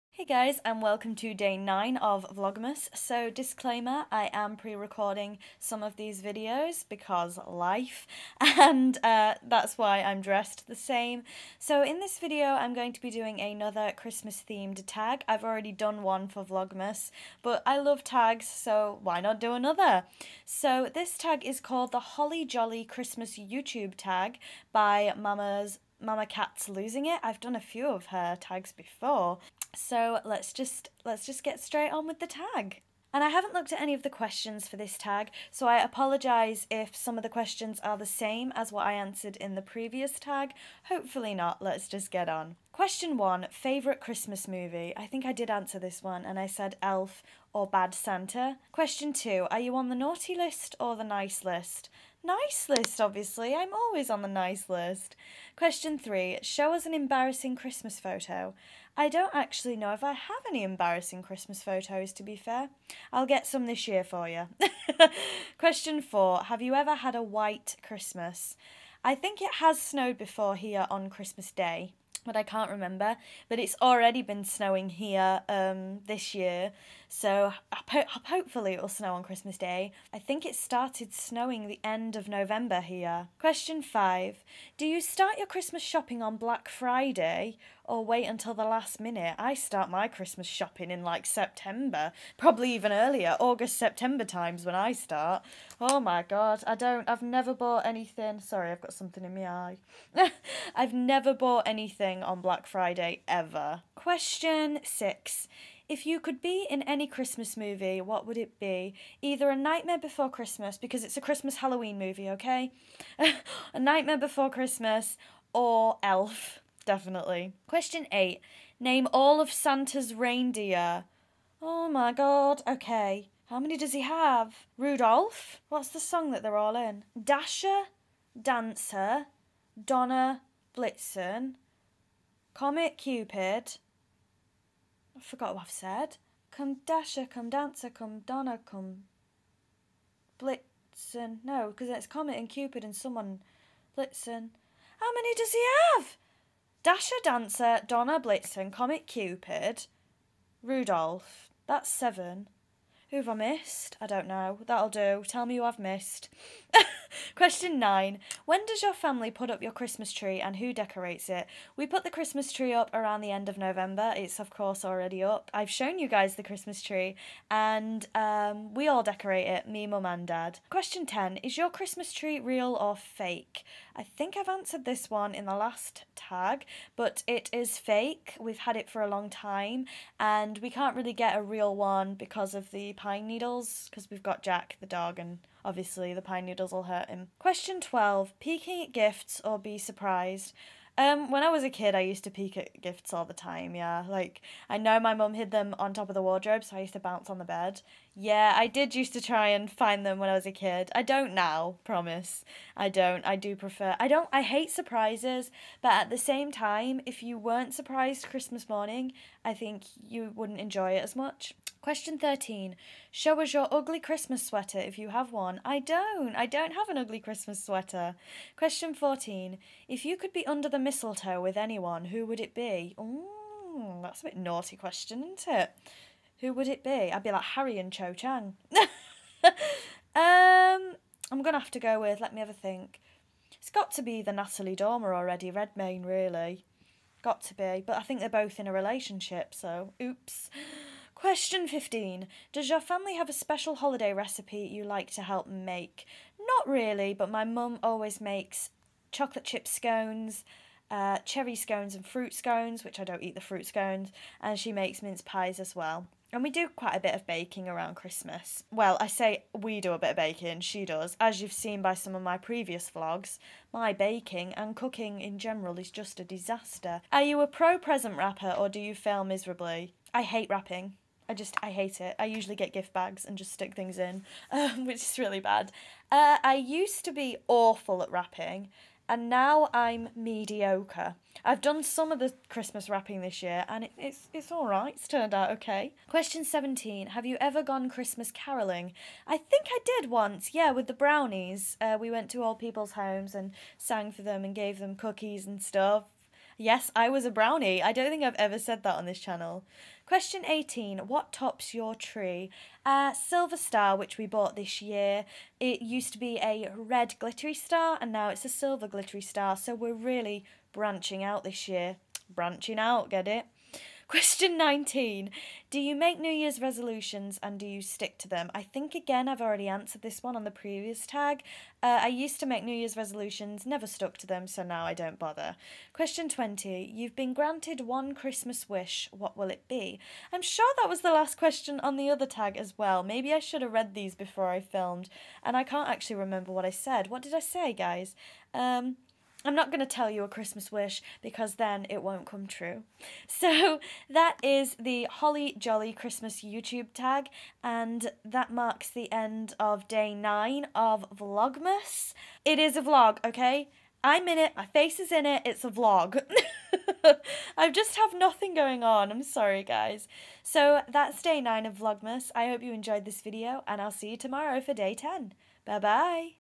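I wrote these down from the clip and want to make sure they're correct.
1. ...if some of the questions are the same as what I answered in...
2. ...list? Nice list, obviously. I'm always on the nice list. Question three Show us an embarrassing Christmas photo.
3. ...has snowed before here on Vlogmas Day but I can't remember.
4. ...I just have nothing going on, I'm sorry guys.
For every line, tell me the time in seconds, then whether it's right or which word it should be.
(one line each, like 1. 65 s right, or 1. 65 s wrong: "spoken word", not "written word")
1. 36 s right
2. 51 s right
3. 69 s wrong: "Christmas", not "Vlogmas"
4. 357 s right.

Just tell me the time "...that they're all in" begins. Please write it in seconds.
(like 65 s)
126 s.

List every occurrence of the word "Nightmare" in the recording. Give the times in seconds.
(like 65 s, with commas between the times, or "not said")
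109 s, 113 s.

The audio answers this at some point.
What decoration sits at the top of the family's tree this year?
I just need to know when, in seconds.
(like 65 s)
303 s.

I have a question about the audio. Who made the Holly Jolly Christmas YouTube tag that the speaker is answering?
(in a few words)
Mama's Mama Cat's losing it.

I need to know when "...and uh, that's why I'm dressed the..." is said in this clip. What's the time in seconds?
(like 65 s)
8 s.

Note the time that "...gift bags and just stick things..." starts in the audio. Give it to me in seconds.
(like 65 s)
272 s.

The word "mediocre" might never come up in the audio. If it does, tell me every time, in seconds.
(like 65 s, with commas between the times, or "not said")
280 s.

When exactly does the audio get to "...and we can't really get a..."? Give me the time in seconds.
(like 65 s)
180 s.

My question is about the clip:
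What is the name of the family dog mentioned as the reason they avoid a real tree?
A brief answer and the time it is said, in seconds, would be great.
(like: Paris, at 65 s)
Jack, at 184 s.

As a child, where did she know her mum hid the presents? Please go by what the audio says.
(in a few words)
On top of the wardrobe.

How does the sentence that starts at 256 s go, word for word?
And we do quite a bit of baking around Christmas.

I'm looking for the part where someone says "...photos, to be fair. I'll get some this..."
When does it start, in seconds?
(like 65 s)
61 s.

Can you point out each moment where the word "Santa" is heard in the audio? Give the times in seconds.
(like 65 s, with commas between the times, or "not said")
47 s, 119 s.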